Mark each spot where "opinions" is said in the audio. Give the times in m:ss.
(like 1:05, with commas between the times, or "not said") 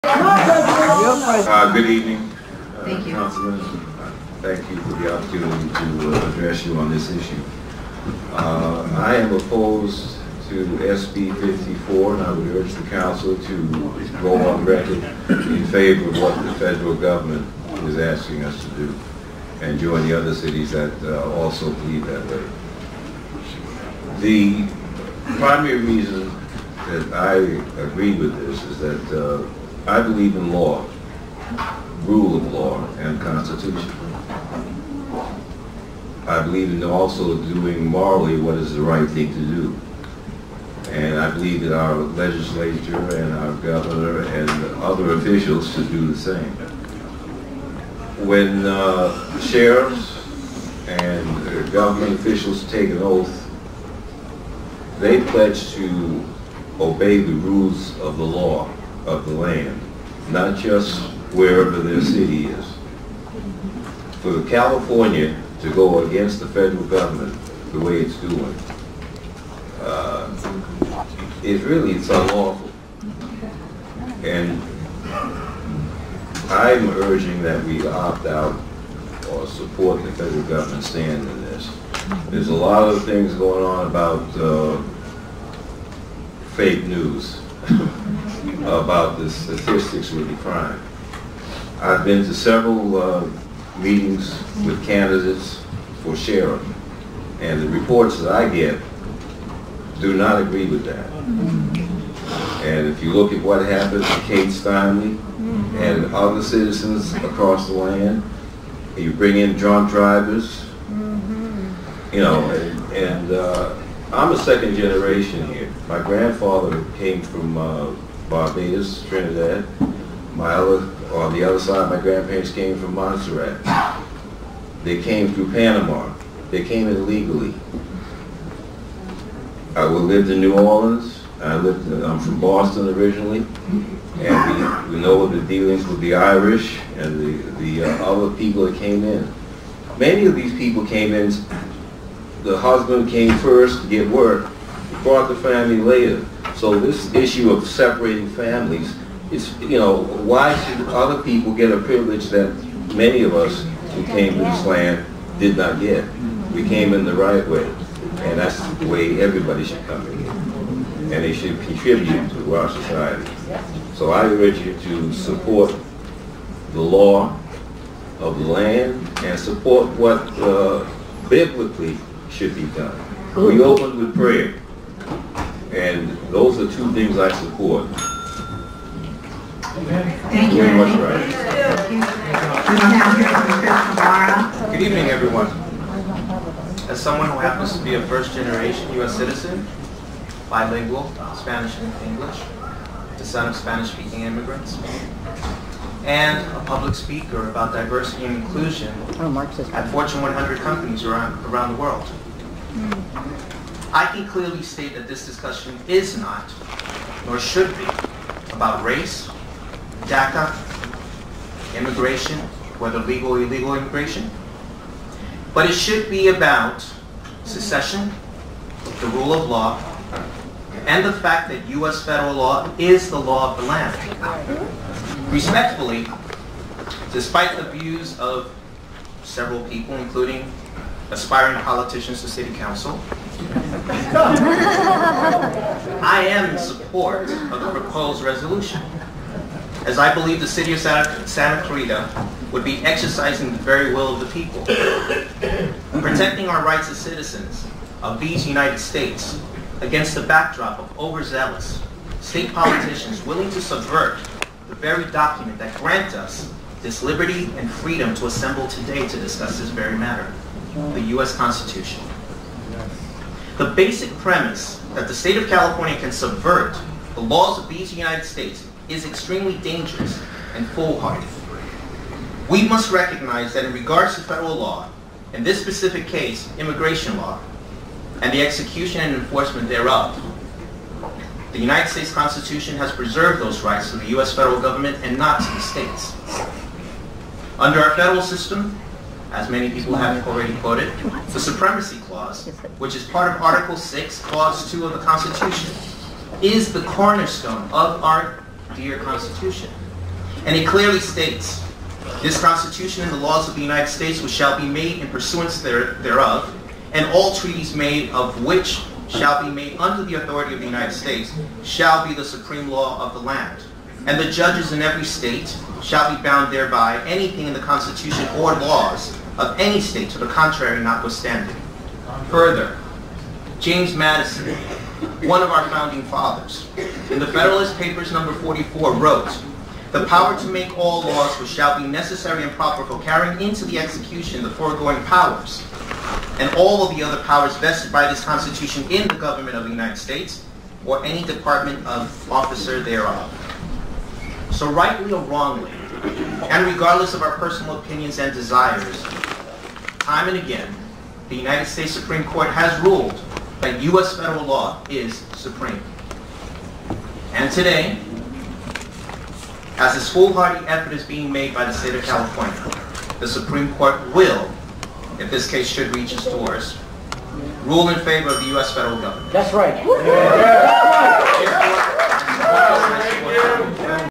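5:47.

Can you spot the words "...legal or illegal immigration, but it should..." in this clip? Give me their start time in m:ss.
3:32.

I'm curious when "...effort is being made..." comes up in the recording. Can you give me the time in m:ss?
6:00.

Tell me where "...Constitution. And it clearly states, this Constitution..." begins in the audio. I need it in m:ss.
4:58.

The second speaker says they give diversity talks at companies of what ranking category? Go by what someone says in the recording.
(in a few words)
Fortune 100.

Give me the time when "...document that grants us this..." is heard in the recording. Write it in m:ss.
4:15.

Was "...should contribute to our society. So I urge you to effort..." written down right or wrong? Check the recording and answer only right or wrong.
wrong.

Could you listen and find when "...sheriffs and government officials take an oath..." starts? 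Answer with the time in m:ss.
0:49.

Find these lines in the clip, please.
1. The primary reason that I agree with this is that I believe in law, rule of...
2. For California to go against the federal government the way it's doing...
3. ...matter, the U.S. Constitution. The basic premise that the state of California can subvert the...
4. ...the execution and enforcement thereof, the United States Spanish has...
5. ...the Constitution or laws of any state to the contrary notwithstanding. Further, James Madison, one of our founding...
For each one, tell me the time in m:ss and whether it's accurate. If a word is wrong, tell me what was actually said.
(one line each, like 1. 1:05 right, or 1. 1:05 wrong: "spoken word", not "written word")
1. 0:24 right
2. 1:04 right
3. 4:19 right
4. 4:38 wrong: "Constitution", not "Spanish"
5. 5:17 right.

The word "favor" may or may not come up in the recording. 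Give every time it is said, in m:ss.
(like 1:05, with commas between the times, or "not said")
0:15, 6:07.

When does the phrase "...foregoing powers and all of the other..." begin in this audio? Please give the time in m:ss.
5:34.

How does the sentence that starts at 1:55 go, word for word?
My grandfather came from uh, Barbados, Trinidad.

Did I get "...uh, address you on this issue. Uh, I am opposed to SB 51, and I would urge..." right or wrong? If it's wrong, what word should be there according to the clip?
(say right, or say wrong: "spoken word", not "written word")
wrong: "54", not "51".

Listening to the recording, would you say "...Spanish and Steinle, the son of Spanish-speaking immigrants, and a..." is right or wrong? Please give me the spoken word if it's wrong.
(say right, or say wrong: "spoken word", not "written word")
wrong: "English", not "Steinle".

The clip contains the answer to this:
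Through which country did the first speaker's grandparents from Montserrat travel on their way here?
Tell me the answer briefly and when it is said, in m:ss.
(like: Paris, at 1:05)
Panama, at 2:05.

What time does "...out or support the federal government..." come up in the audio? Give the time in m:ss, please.
1:18.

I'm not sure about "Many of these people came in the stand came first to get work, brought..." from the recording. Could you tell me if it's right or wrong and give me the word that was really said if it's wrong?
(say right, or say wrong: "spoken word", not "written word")
wrong: "husband", not "stand".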